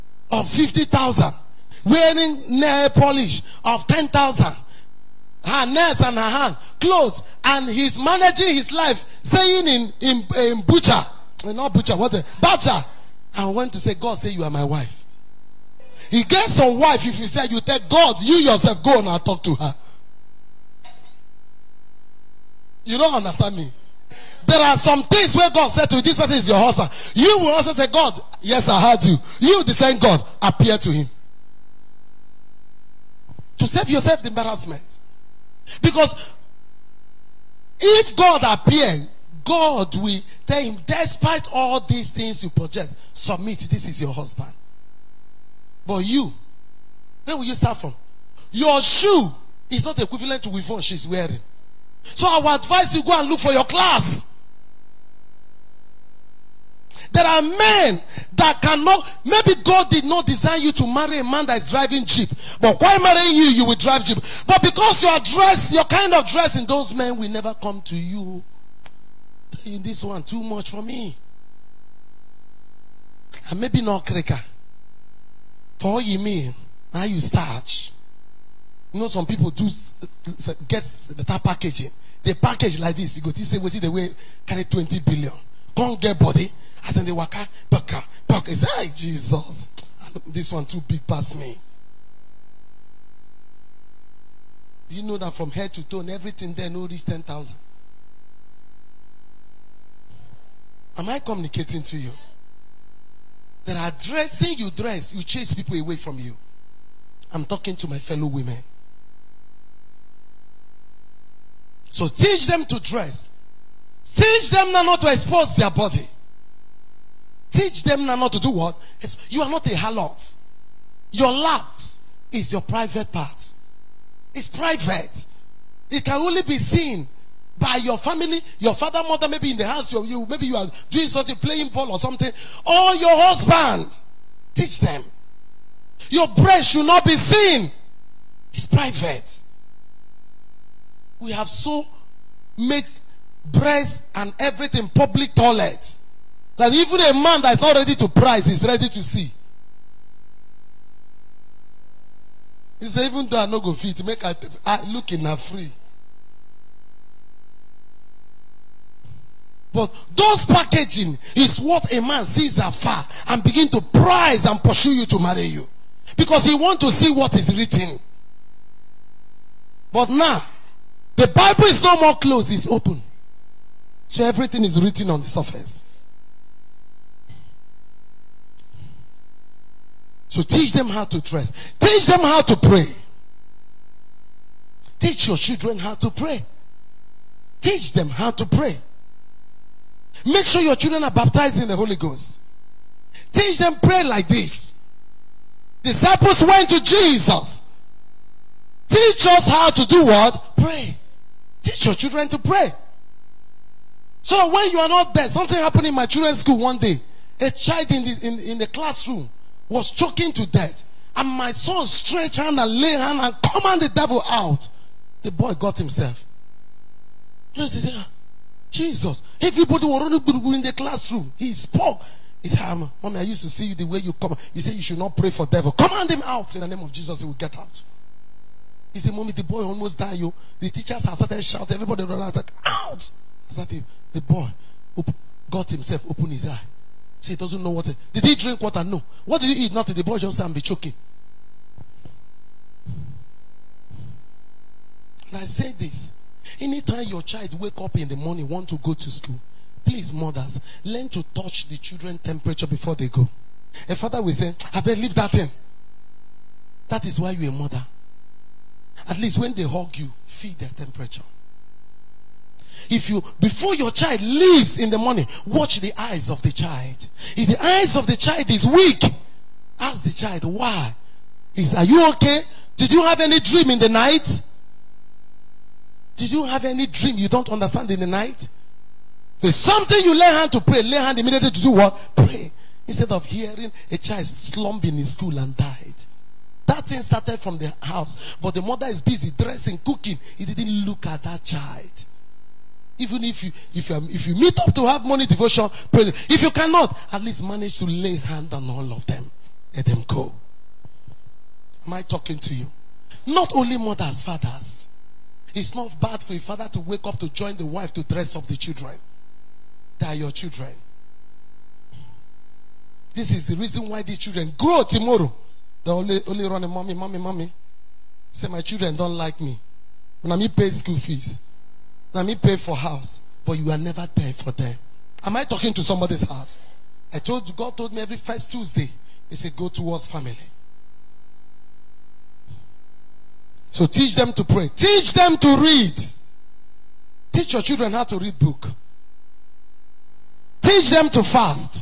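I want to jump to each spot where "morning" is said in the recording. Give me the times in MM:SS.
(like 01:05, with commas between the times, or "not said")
04:08, 04:24.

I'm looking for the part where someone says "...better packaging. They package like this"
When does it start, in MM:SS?
01:21.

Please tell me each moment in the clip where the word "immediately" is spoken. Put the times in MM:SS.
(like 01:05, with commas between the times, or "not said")
04:41.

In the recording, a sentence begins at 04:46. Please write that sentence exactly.
That thing started from the house.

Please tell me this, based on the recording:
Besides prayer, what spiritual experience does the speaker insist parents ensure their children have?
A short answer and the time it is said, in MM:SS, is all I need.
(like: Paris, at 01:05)
baptized in the Holy Ghost, at 03:11.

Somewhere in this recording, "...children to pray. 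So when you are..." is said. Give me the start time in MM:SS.
03:21.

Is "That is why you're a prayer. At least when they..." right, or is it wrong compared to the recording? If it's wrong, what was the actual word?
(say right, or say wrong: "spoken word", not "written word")
wrong: "mother", not "prayer".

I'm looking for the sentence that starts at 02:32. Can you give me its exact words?
He said, even though I no go fit, make I, I look in a free.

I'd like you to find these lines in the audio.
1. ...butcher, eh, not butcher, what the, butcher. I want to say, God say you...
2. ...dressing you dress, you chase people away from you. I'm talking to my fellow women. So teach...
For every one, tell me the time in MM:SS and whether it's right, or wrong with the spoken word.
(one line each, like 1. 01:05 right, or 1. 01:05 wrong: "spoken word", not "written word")
1. 00:10 right
2. 01:44 right.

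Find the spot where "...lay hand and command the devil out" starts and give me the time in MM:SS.
03:32.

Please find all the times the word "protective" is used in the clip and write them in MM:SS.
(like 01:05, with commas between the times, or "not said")
not said.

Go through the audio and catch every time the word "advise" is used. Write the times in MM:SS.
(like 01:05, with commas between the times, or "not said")
00:52.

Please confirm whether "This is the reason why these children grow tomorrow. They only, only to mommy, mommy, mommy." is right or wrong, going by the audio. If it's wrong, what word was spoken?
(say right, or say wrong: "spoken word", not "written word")
right.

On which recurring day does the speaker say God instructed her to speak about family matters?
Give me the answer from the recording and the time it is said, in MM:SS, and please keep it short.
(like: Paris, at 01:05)
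every first Tuesday, at 05:28.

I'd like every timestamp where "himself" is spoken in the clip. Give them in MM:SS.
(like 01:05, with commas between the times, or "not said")
03:35, 03:55.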